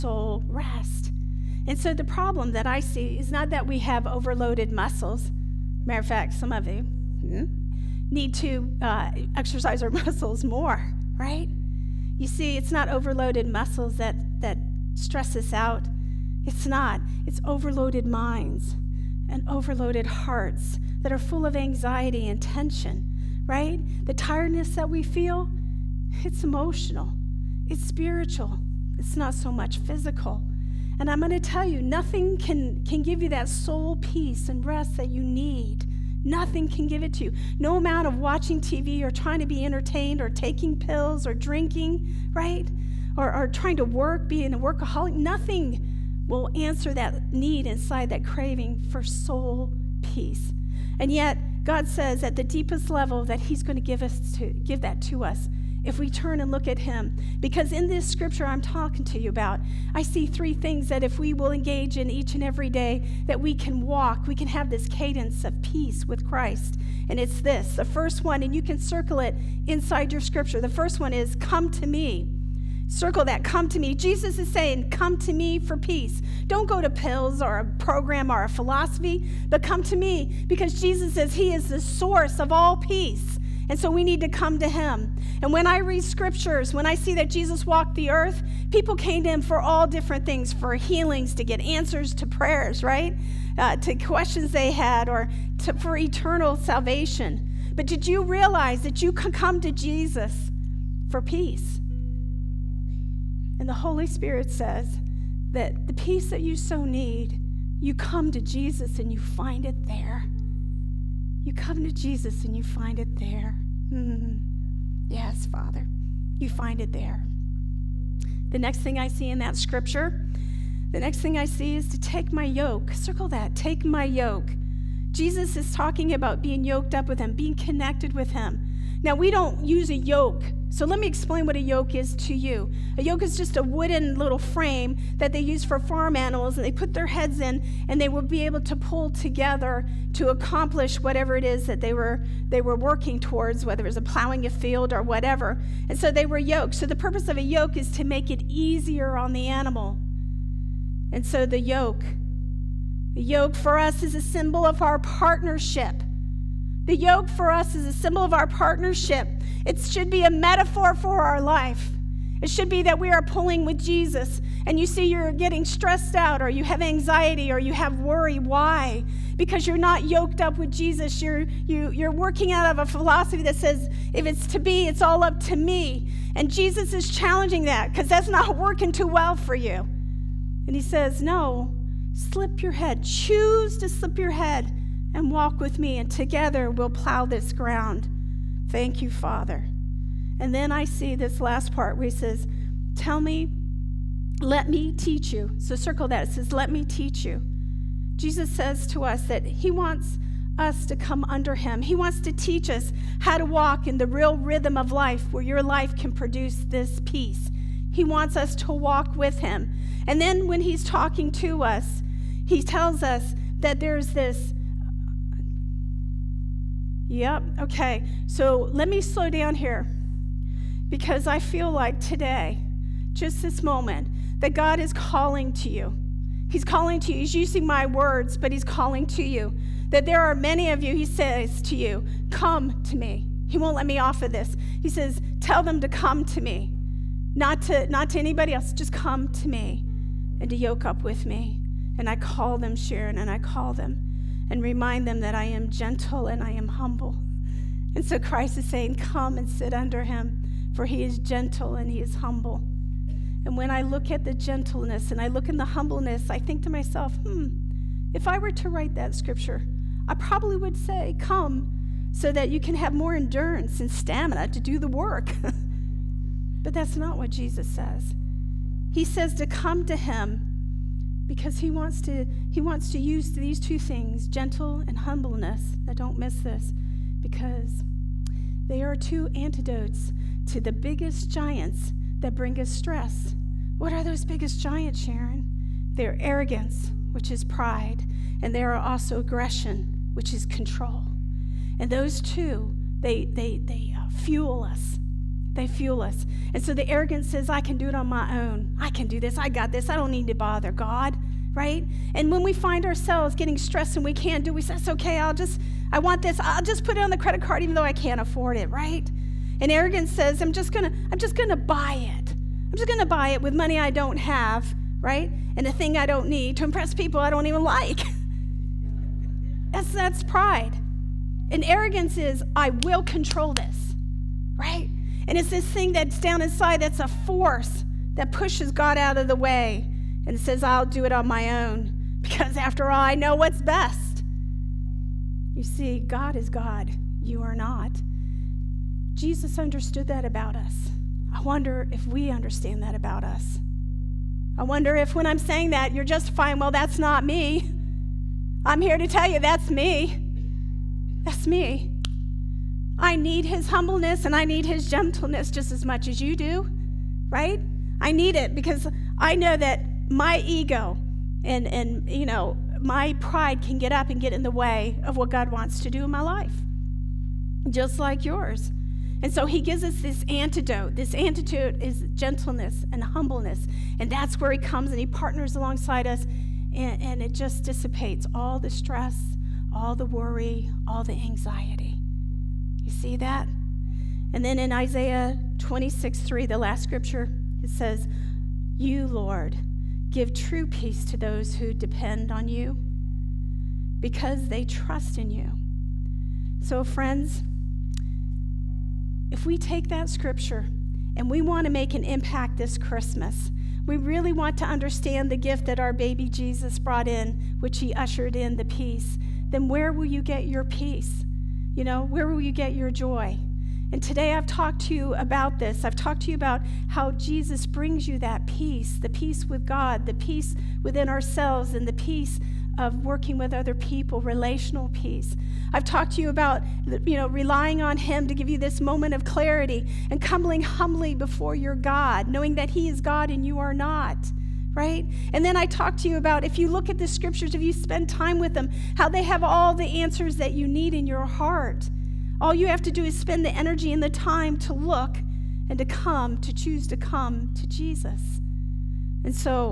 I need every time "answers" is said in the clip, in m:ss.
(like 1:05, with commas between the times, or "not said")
0:46, 1:31, 7:20.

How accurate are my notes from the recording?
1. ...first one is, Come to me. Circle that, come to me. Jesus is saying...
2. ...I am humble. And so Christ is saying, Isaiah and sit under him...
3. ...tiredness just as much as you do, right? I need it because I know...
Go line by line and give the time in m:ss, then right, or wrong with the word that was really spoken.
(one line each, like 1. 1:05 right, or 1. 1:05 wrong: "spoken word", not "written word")
1. 1:10 right
2. 4:06 wrong: "Come", not "Isaiah"
3. 5:54 wrong: "gentleness", not "tiredness".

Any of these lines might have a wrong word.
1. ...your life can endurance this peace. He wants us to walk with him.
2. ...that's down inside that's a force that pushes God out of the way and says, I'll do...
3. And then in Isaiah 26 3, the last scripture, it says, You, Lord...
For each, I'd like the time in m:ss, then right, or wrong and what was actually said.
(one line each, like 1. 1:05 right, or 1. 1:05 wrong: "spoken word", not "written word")
1. 3:25 wrong: "produce", not "endurance"
2. 5:25 right
3. 6:24 right.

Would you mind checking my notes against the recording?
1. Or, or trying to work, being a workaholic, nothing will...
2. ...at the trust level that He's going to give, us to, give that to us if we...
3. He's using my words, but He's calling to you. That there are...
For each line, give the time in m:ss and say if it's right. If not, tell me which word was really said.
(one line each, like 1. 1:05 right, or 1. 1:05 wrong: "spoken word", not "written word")
1. 0:43 right
2. 0:52 wrong: "deepest", not "trust"
3. 3:47 right.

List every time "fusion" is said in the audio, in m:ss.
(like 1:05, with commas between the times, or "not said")
not said.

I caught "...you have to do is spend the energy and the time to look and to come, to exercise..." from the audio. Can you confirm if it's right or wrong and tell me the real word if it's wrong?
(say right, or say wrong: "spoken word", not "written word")
wrong: "choose", not "exercise".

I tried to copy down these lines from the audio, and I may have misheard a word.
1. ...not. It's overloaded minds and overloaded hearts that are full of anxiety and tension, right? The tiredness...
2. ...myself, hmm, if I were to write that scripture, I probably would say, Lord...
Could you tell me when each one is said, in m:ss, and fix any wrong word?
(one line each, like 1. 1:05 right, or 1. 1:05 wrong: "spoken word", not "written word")
1. 0:16 right
2. 4:16 wrong: "Come", not "Lord".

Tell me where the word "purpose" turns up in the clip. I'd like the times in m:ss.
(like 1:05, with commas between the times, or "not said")
2:26.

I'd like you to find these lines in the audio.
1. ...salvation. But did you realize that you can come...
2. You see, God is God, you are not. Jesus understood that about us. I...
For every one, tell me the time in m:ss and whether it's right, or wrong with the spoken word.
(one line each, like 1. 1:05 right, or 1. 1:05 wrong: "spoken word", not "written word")
1. 1:36 right
2. 5:35 right.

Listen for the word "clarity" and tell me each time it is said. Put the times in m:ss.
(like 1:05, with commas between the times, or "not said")
7:09.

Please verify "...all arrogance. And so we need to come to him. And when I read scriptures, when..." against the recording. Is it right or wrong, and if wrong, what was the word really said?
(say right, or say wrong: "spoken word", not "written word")
wrong: "peace", not "arrogance".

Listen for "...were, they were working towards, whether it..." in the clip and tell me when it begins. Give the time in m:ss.
2:21.